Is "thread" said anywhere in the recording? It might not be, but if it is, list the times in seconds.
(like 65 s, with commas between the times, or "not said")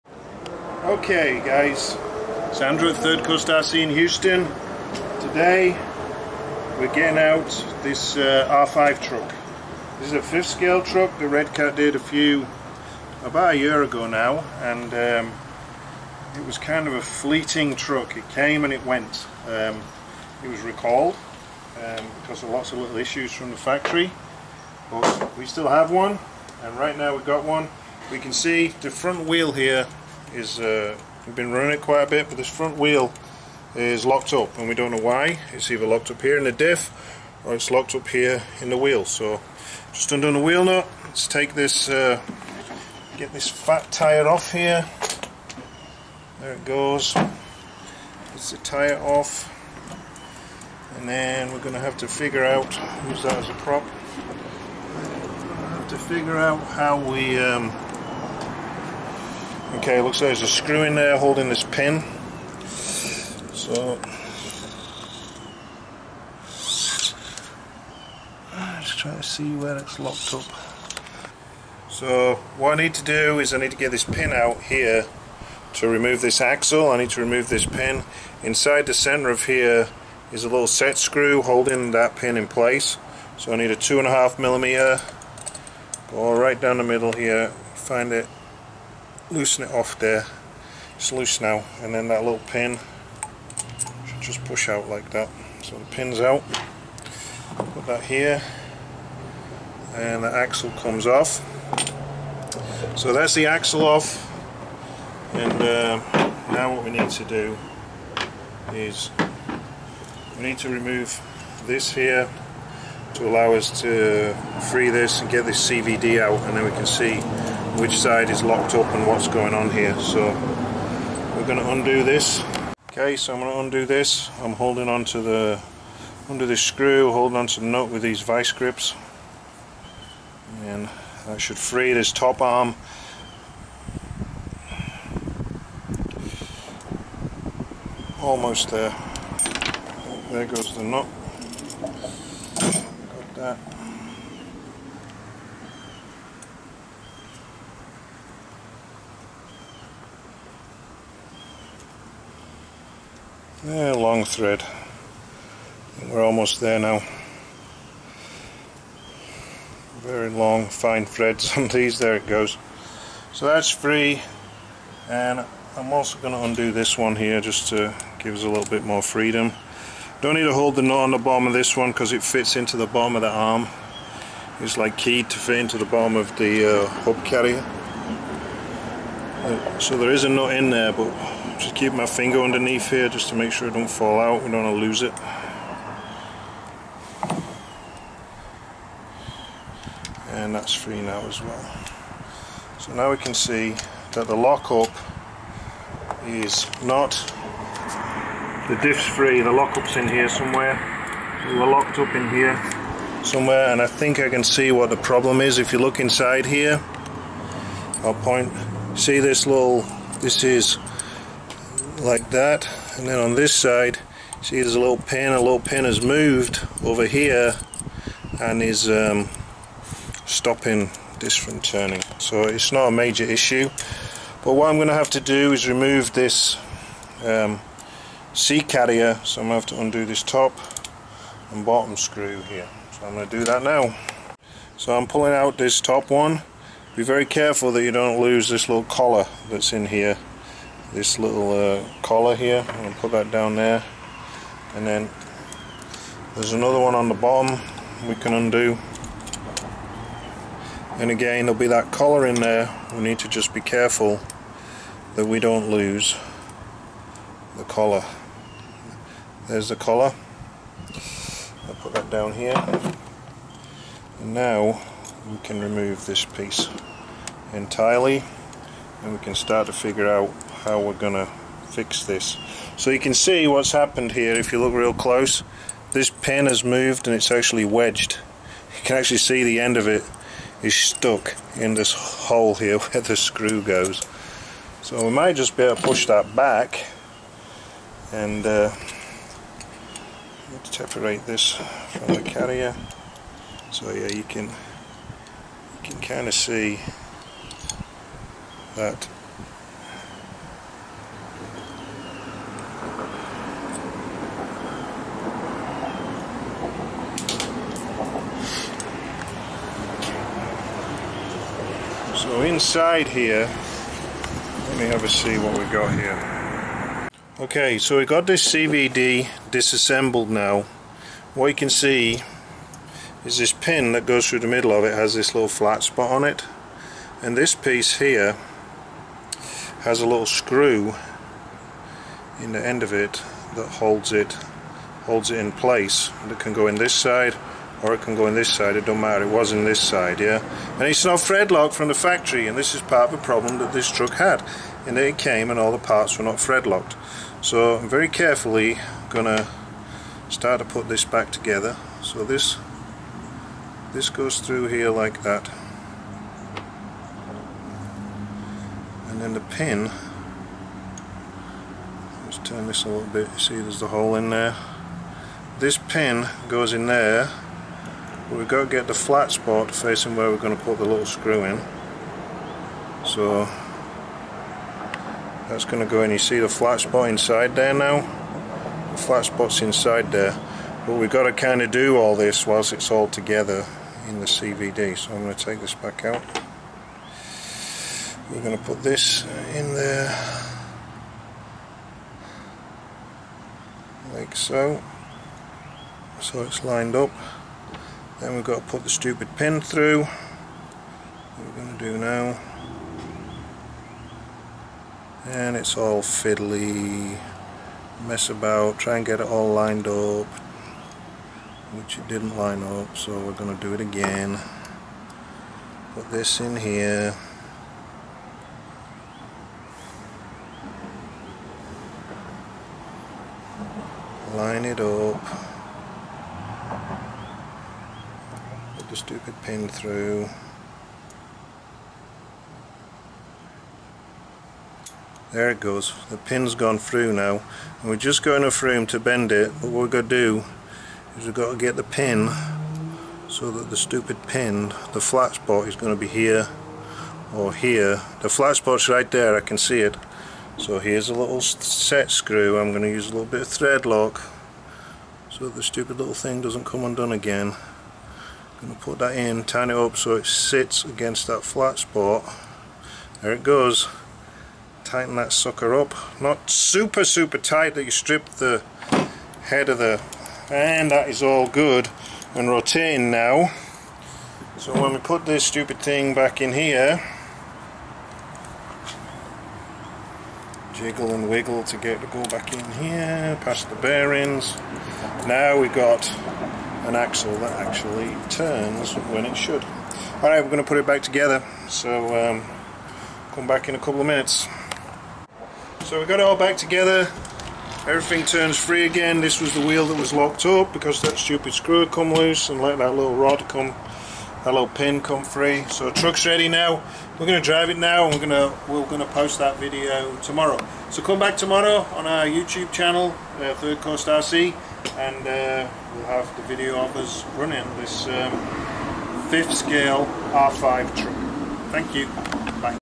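154 s, 161 s, 341 s, 346 s, 453 s.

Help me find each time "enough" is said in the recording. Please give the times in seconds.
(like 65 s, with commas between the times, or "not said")
438 s.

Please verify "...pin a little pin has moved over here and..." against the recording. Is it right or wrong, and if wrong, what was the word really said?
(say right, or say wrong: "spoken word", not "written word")
right.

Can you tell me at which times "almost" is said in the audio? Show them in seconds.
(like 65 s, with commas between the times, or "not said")
138 s, 156 s.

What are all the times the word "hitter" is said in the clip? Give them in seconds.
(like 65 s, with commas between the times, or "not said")
not said.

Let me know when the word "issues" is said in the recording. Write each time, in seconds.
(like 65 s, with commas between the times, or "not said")
22 s, 223 s.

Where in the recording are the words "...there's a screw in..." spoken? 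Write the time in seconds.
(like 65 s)
60 s.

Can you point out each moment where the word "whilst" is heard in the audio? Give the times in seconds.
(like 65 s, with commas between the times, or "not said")
382 s.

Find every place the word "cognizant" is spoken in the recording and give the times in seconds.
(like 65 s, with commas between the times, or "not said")
not said.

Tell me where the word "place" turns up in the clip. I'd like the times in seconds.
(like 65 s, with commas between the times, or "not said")
82 s, 335 s.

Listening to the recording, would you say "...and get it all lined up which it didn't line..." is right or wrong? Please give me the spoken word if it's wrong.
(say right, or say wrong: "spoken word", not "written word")
right.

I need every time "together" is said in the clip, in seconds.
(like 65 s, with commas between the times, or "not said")
351 s, 383 s, 491 s, 496 s.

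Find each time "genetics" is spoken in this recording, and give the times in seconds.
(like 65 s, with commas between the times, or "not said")
not said.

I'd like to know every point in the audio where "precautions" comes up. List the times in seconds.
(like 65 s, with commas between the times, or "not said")
not said.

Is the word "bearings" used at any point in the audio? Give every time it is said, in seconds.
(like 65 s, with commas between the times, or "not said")
483 s.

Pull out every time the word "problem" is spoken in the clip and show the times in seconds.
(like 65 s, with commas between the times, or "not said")
204 s, 343 s.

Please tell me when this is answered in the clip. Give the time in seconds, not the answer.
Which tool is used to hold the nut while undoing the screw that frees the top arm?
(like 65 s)
128 s.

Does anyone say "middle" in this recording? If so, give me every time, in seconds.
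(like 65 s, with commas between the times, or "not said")
86 s, 324 s.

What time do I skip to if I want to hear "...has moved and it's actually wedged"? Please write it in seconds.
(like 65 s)
276 s.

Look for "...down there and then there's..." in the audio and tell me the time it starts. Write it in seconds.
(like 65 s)
243 s.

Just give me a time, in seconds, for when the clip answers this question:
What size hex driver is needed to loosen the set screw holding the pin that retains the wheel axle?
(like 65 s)
83 s.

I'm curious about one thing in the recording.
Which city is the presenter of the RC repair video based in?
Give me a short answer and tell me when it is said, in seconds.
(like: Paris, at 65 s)
Houston, at 3 s.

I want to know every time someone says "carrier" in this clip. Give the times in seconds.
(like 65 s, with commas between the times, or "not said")
177 s, 228 s, 292 s.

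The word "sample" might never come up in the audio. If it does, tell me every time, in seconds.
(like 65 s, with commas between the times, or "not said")
not said.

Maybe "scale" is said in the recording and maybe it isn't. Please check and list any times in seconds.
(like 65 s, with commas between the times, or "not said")
10 s, 519 s.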